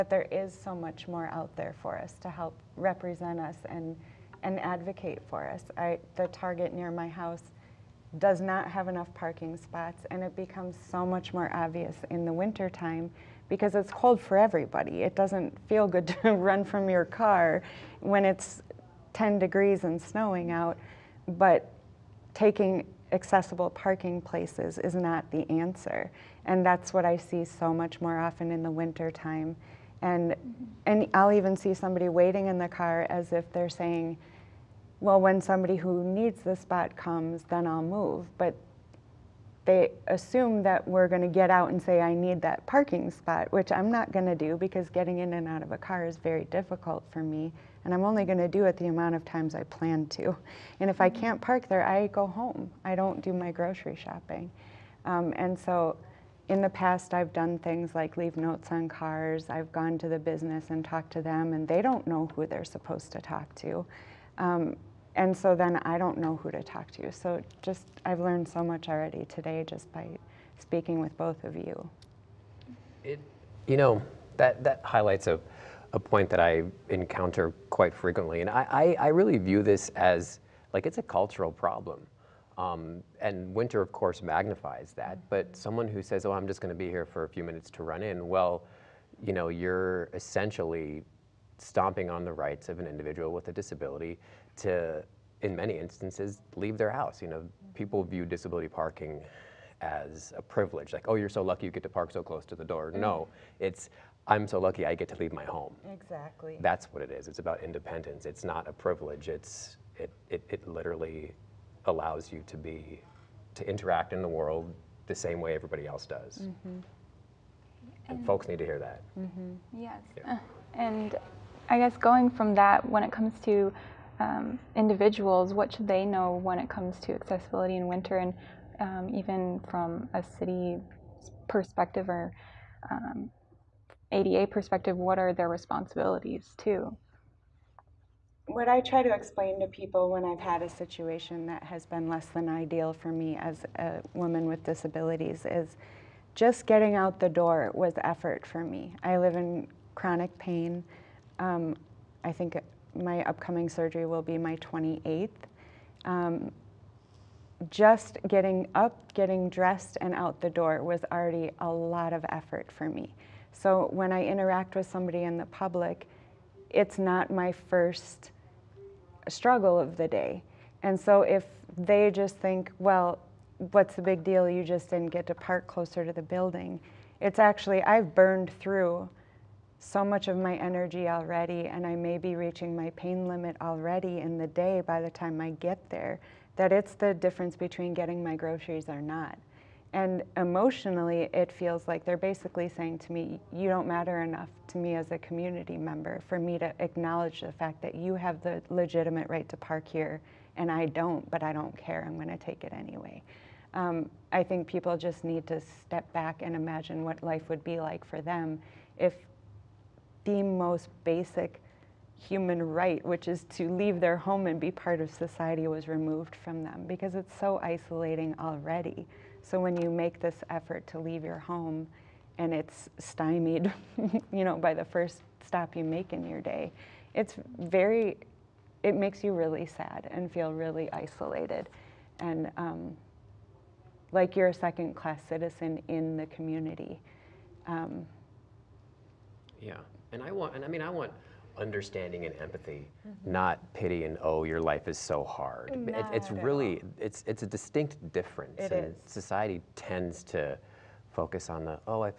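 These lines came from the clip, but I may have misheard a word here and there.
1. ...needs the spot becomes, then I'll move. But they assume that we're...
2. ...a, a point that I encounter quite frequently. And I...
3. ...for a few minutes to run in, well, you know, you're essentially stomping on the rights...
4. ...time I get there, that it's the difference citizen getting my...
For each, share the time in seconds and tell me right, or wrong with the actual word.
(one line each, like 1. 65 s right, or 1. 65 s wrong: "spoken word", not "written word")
1. 36 s wrong: "comes", not "becomes"
2. 75 s right
3. 87 s right
4. 185 s wrong: "between", not "citizen".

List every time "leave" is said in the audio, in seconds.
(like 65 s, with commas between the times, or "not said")
58 s, 96 s, 105 s, 213 s, 220 s.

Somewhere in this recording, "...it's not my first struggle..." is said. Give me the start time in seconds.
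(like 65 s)
166 s.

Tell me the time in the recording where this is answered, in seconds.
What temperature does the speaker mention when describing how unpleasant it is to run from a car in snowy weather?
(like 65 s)
19 s.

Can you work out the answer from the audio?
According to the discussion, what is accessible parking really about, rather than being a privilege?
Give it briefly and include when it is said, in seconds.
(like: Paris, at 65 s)
independence, at 107 s.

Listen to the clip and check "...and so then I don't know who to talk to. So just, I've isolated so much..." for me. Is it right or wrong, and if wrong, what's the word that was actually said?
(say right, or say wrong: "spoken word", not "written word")
wrong: "learned", not "isolated".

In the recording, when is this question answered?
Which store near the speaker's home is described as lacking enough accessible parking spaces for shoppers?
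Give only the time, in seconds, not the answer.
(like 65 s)
6 s.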